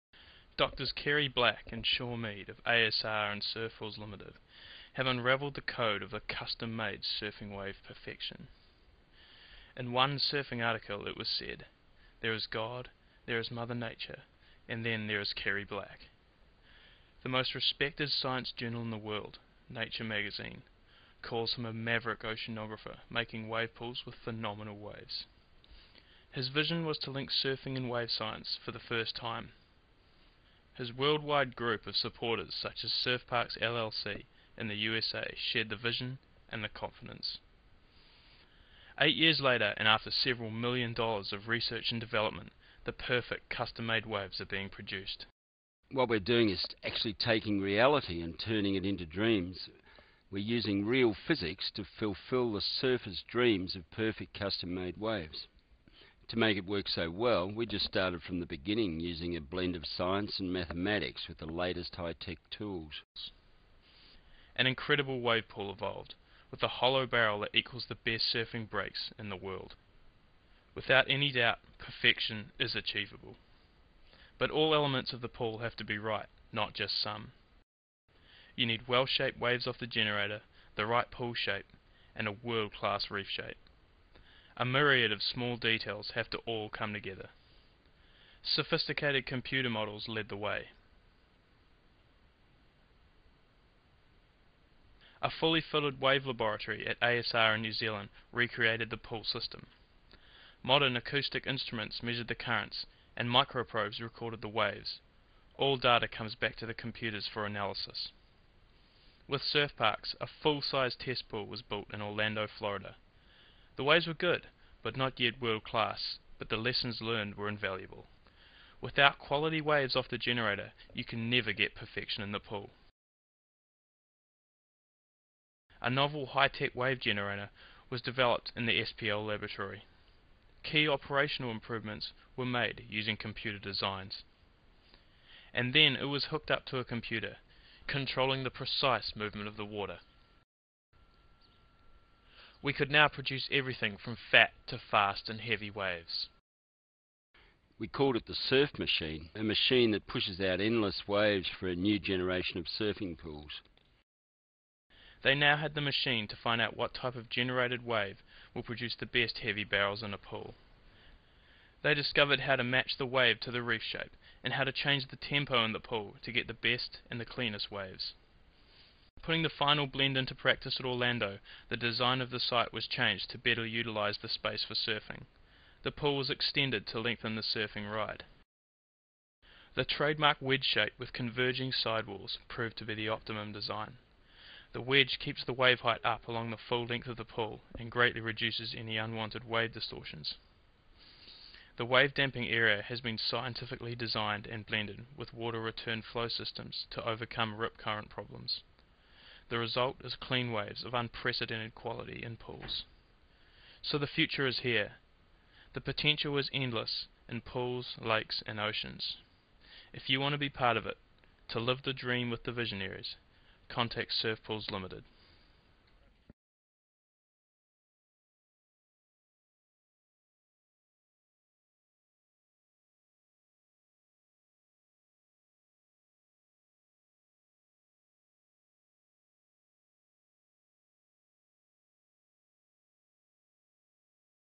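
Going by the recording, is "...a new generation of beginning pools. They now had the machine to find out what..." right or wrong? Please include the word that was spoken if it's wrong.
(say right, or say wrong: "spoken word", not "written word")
wrong: "surfing", not "beginning".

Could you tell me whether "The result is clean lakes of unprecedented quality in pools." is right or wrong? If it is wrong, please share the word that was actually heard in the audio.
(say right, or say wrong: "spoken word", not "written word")
wrong: "waves", not "lakes".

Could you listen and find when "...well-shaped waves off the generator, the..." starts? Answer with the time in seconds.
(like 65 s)
78 s.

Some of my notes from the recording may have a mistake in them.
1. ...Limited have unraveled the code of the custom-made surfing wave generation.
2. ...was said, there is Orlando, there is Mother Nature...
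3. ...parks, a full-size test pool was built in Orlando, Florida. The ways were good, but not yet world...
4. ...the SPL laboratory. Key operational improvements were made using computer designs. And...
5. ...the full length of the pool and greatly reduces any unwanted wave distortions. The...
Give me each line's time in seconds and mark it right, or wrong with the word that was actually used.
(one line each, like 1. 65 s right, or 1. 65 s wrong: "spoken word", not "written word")
1. 3 s wrong: "perfection", not "generation"
2. 11 s wrong: "God", not "Orlando"
3. 109 s right
4. 128 s right
5. 186 s right.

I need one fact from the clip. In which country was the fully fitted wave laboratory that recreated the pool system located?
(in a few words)
New Zealand.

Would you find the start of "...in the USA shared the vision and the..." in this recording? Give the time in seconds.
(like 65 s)
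34 s.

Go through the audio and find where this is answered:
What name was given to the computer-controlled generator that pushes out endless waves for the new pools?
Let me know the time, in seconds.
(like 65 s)
148 s.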